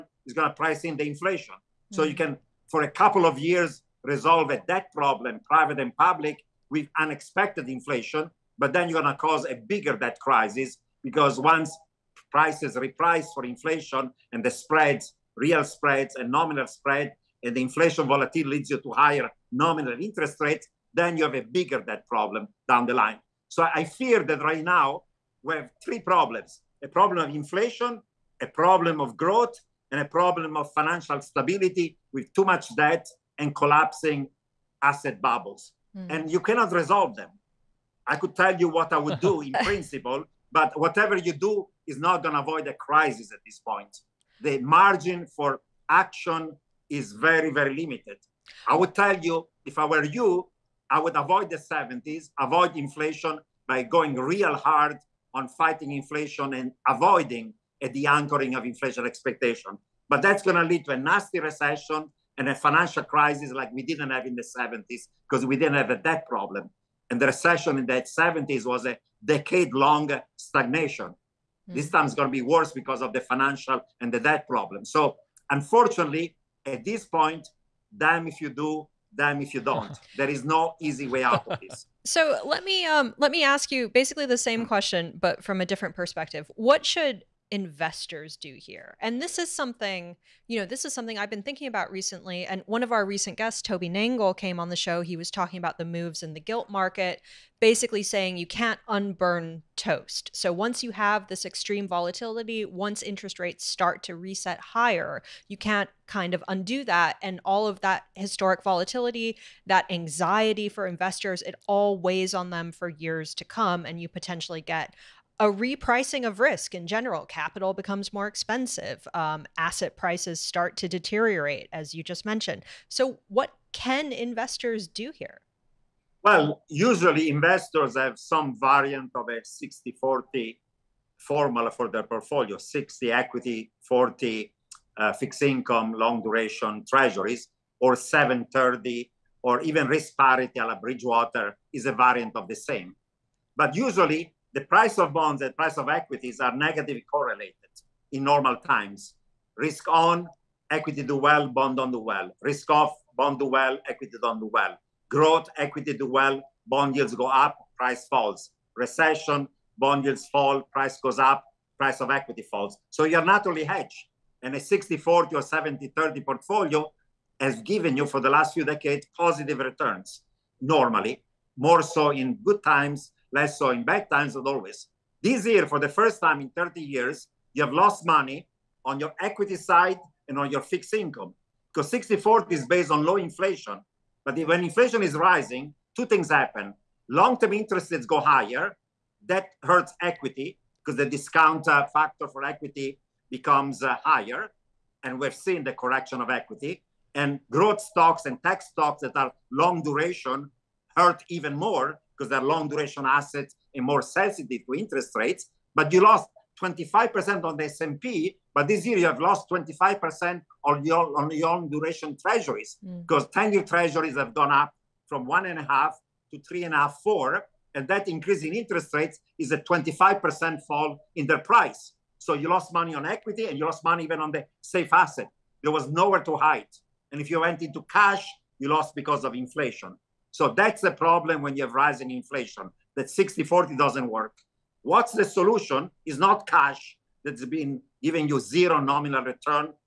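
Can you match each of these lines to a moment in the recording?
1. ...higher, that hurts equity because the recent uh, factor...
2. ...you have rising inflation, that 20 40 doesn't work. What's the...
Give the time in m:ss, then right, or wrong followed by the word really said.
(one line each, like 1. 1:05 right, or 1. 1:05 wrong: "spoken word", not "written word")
1. 3:08 wrong: "discount", not "recent"
2. 3:51 wrong: "60", not "20".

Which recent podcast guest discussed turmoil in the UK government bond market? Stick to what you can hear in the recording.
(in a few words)
Toby Nangle.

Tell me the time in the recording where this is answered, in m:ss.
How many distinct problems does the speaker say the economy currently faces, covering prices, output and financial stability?
0:25.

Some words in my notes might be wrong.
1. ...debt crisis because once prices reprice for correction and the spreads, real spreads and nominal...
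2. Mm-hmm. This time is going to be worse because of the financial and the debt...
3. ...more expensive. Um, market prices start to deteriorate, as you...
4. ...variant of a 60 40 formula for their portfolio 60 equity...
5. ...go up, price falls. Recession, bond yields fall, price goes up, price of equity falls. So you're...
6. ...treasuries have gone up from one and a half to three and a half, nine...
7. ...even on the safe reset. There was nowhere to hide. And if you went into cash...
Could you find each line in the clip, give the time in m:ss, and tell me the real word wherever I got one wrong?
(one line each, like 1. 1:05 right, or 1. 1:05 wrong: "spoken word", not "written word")
1. 0:09 wrong: "inflation", not "correction"
2. 1:11 right
3. 1:58 wrong: "asset", not "market"
4. 2:08 right
5. 2:37 right
6. 3:33 wrong: "four", not "nine"
7. 3:44 wrong: "asset", not "reset".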